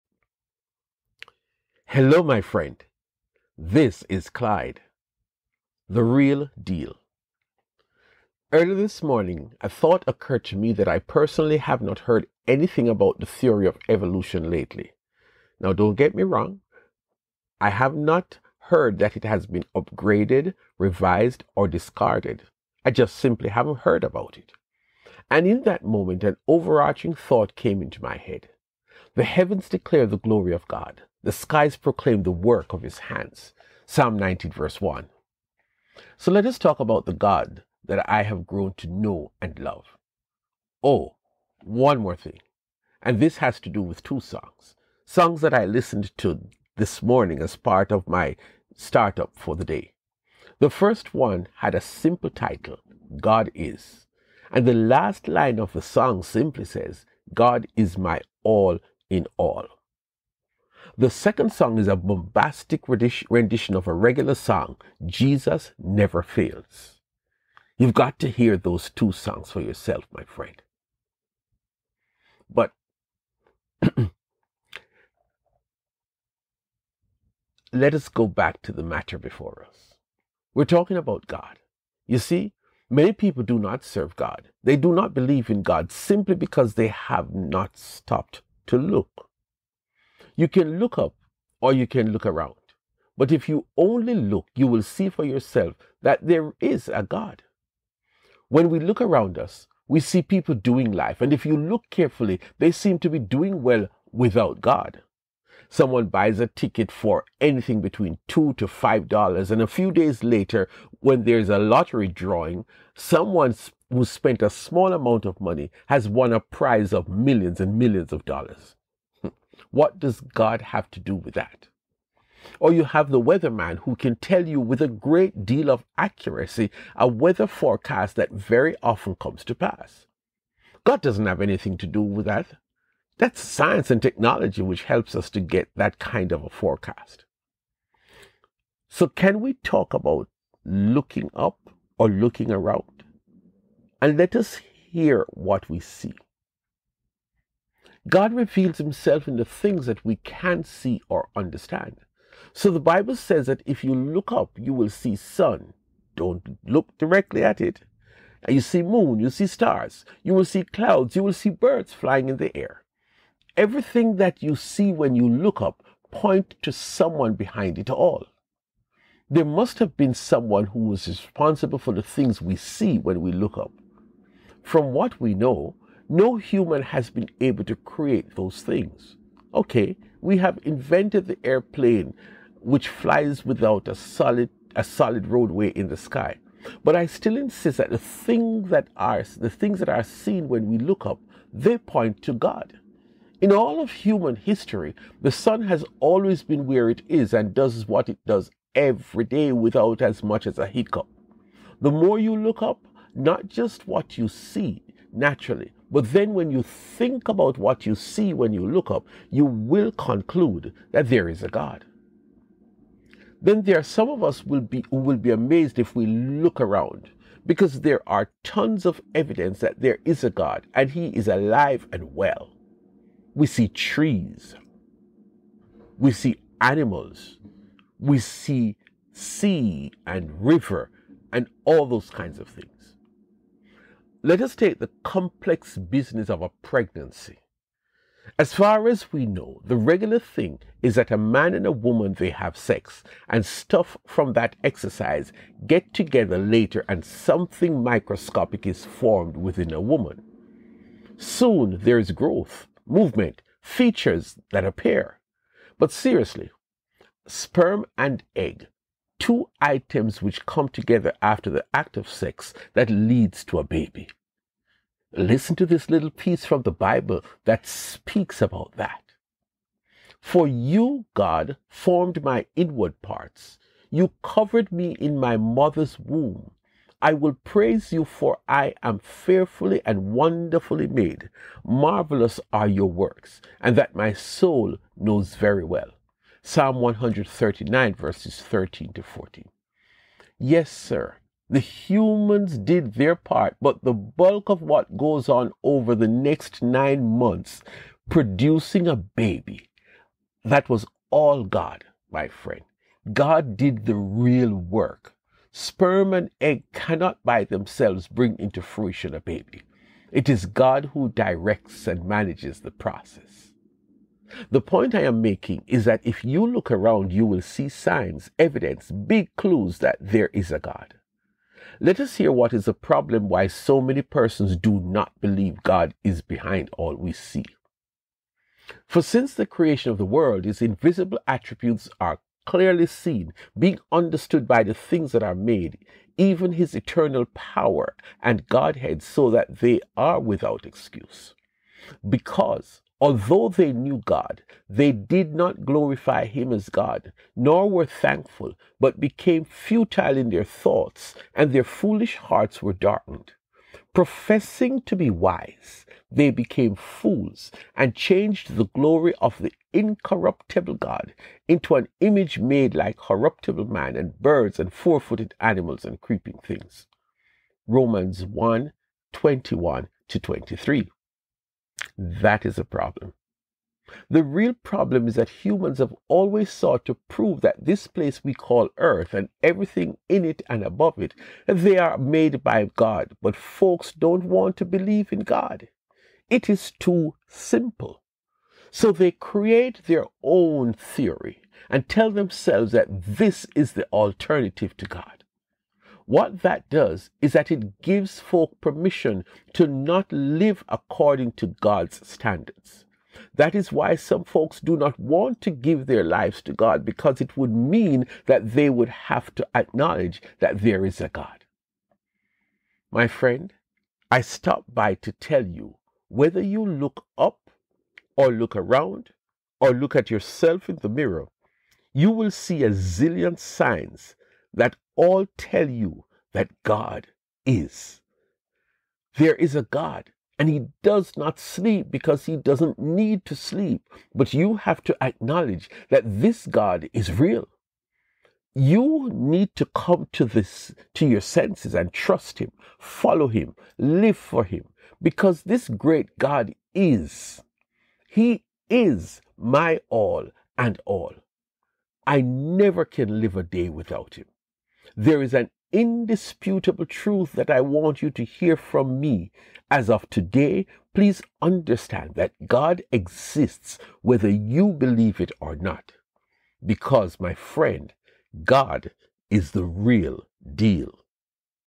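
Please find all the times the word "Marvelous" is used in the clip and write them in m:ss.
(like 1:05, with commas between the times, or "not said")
4:41.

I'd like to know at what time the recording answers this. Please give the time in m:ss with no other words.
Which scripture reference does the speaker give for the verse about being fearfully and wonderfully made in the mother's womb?
4:46.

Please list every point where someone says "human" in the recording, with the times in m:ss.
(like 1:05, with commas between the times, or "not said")
2:56, 3:13, 4:51, 6:15.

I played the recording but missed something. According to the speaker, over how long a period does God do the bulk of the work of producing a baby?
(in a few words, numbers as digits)
9 months.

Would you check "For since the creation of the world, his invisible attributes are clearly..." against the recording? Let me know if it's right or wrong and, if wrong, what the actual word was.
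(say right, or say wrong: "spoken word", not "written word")
right.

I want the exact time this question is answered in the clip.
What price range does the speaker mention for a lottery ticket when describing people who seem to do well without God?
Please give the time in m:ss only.
1:48.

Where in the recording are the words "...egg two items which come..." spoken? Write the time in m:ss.
4:18.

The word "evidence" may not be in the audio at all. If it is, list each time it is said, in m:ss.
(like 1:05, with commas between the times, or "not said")
3:39, 5:18.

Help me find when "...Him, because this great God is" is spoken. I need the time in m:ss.
7:24.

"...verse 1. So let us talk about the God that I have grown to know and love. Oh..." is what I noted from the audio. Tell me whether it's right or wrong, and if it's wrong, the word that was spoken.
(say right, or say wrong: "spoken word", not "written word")
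right.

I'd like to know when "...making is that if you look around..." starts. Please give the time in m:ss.
5:15.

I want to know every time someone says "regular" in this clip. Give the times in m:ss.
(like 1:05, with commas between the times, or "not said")
1:03, 3:59.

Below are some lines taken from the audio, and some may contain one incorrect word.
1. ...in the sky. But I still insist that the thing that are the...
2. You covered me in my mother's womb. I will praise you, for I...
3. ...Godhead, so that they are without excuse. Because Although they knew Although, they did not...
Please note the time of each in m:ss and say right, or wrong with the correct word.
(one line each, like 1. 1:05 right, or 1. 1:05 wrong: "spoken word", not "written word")
1. 3:05 right
2. 4:33 right
3. 5:38 wrong: "God", not "Although".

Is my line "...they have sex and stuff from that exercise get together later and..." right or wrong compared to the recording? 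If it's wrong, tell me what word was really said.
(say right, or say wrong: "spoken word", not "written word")
right.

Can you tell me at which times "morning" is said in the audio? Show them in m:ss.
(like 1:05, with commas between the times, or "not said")
0:09, 0:47.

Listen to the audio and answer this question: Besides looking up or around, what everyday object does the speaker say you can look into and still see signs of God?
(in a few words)
The mirror.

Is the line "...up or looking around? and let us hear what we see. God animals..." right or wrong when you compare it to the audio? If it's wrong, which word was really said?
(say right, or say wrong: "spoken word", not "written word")
wrong: "reveals", not "animals".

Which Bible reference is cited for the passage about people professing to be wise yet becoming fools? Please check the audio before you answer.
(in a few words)
Romans 1:21-23.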